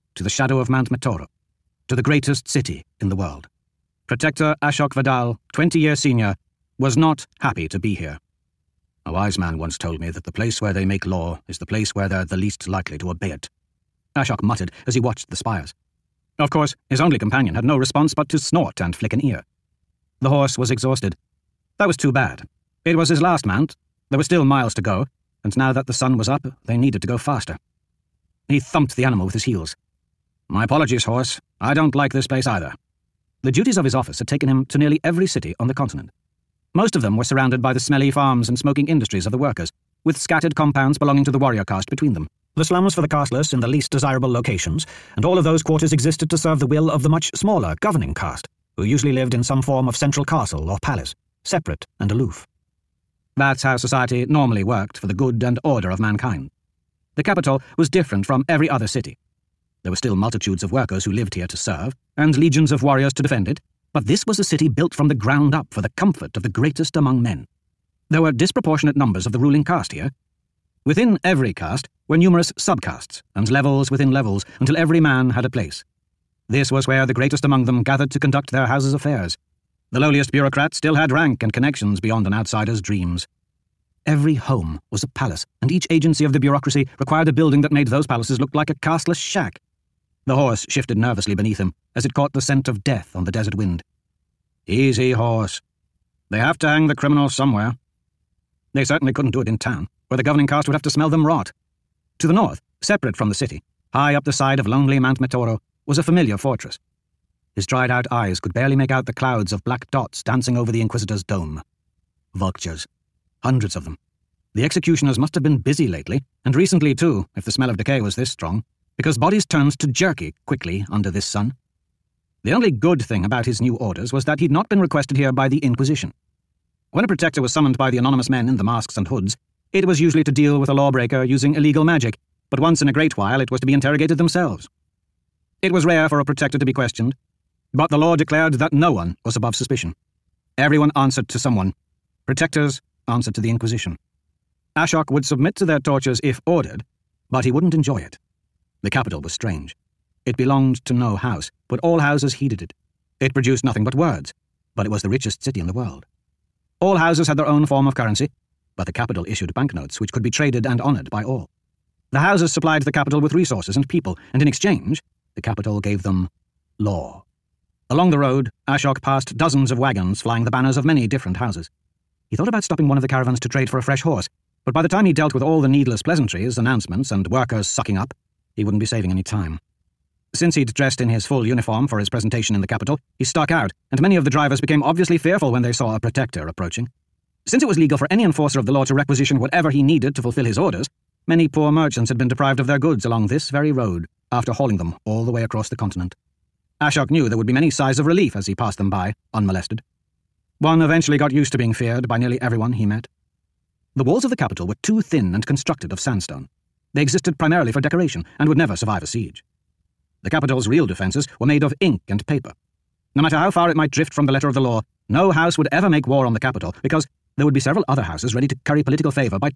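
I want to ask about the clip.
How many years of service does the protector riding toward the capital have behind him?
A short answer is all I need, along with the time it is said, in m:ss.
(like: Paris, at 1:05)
20, at 0:05.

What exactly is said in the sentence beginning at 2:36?
All houses had their own form of currency, but the capital issued banknotes which could be traded and honoured by all.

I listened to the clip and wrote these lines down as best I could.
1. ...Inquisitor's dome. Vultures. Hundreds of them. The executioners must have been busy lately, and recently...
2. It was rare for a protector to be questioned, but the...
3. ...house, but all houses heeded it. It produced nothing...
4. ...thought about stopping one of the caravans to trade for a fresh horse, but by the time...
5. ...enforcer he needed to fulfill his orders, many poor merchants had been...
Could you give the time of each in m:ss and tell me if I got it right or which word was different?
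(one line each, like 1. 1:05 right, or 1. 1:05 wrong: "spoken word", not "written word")
1. 1:50 right
2. 2:15 right
3. 2:31 right
4. 2:52 right
5. 3:09 wrong: "whatever", not "enforcer".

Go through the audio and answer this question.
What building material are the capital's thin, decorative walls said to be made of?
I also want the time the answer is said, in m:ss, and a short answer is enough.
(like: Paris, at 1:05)
Sandstone, at 3:25.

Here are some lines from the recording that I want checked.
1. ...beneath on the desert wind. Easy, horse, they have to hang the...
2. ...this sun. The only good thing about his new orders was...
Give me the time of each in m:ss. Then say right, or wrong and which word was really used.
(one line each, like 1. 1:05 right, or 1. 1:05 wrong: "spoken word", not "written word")
1. 1:32 wrong: "death", not "beneath"
2. 2:01 right.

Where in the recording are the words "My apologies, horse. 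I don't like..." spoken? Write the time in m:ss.
0:30.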